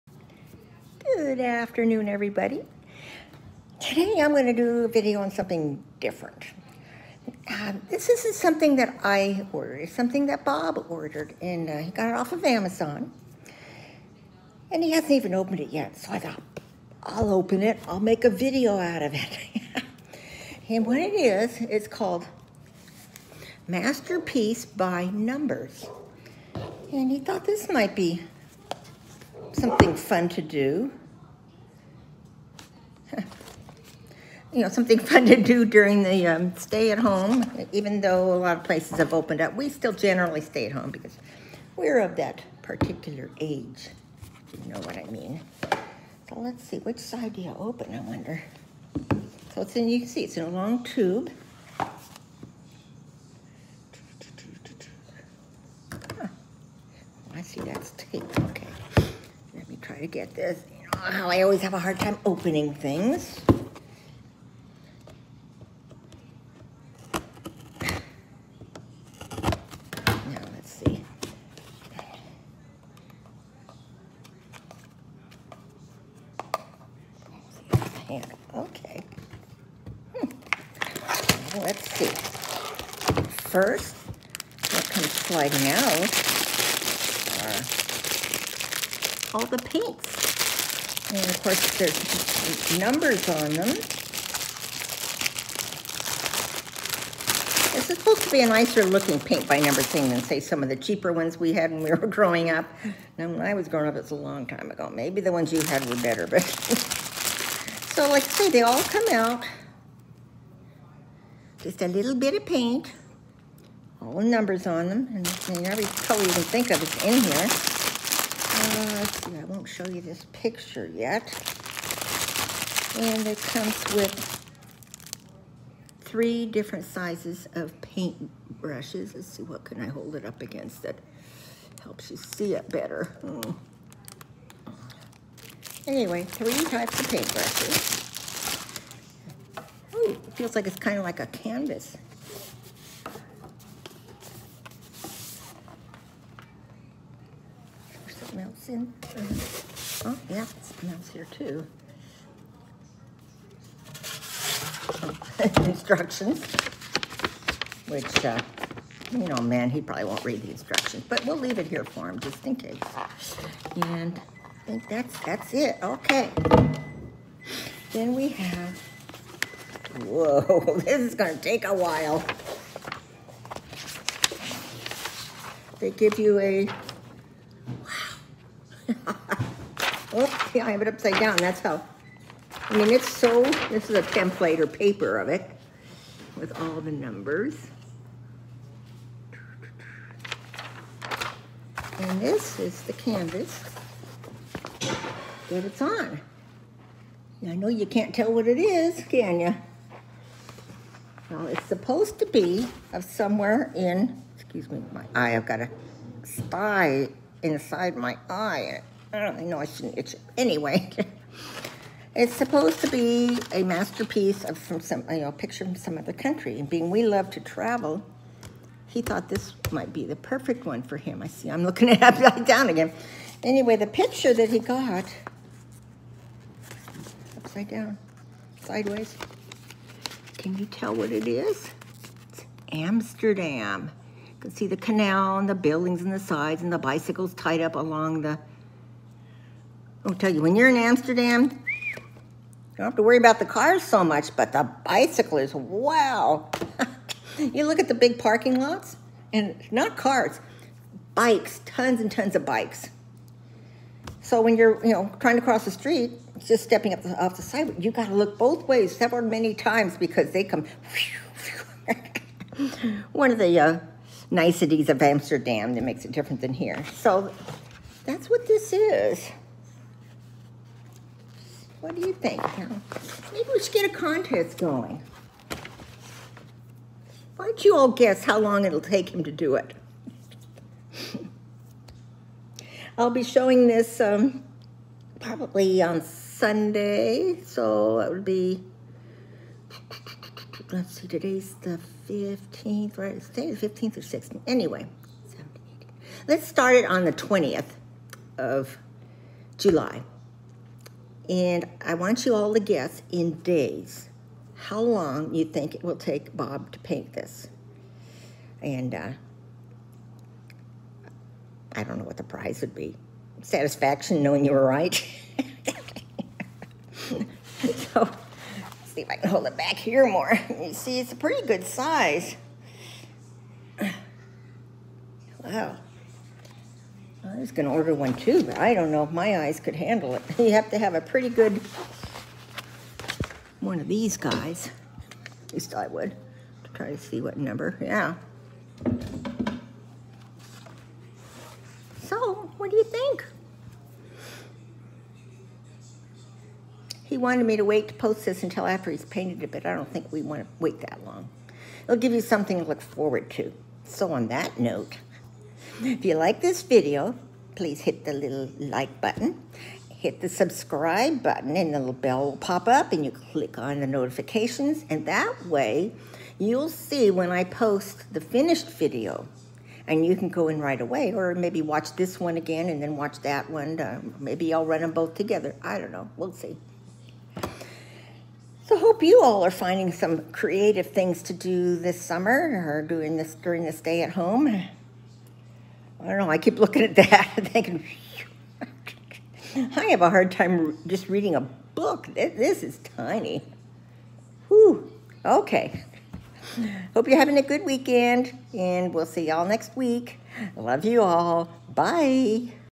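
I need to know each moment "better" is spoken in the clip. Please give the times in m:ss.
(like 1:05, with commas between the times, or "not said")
1:45, 2:12.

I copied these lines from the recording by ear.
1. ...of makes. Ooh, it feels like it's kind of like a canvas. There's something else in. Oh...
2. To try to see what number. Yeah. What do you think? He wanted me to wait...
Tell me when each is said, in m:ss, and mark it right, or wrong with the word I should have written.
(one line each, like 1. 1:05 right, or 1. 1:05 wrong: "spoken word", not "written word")
1. 2:16 wrong: "paintbrushes", not "makes"
2. 5:36 right.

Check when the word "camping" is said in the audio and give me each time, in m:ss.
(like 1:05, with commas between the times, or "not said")
not said.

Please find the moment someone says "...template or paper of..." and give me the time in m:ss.
3:04.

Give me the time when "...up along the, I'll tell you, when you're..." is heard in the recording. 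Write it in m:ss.
3:57.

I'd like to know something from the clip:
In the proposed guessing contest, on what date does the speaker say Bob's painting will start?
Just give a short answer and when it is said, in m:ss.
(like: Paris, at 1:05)
July 20, at 4:57.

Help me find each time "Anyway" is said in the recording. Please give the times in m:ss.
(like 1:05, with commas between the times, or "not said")
2:15, 3:30, 3:43, 4:54.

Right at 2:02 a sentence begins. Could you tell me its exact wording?
And it comes with three different sizes of paint brushes.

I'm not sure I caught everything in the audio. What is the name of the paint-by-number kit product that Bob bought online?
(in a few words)
Masterpiece by Numbers.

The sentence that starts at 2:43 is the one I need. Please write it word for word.
And I think that's, that's it.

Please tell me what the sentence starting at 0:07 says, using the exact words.
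Uh, this isn't something that I ordered.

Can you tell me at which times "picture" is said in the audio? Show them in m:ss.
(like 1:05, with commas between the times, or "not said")
2:00, 3:35, 3:43.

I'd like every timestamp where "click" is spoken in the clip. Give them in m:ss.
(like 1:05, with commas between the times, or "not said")
6:03.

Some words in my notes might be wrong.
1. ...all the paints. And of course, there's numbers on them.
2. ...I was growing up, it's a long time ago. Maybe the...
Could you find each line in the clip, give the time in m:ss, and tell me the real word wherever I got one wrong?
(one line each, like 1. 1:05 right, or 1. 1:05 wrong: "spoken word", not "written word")
1. 1:29 right
2. 1:43 right.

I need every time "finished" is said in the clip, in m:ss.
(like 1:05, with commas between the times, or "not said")
6:08.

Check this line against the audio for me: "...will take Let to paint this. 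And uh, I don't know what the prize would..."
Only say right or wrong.
wrong.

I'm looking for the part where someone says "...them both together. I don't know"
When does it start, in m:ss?
6:14.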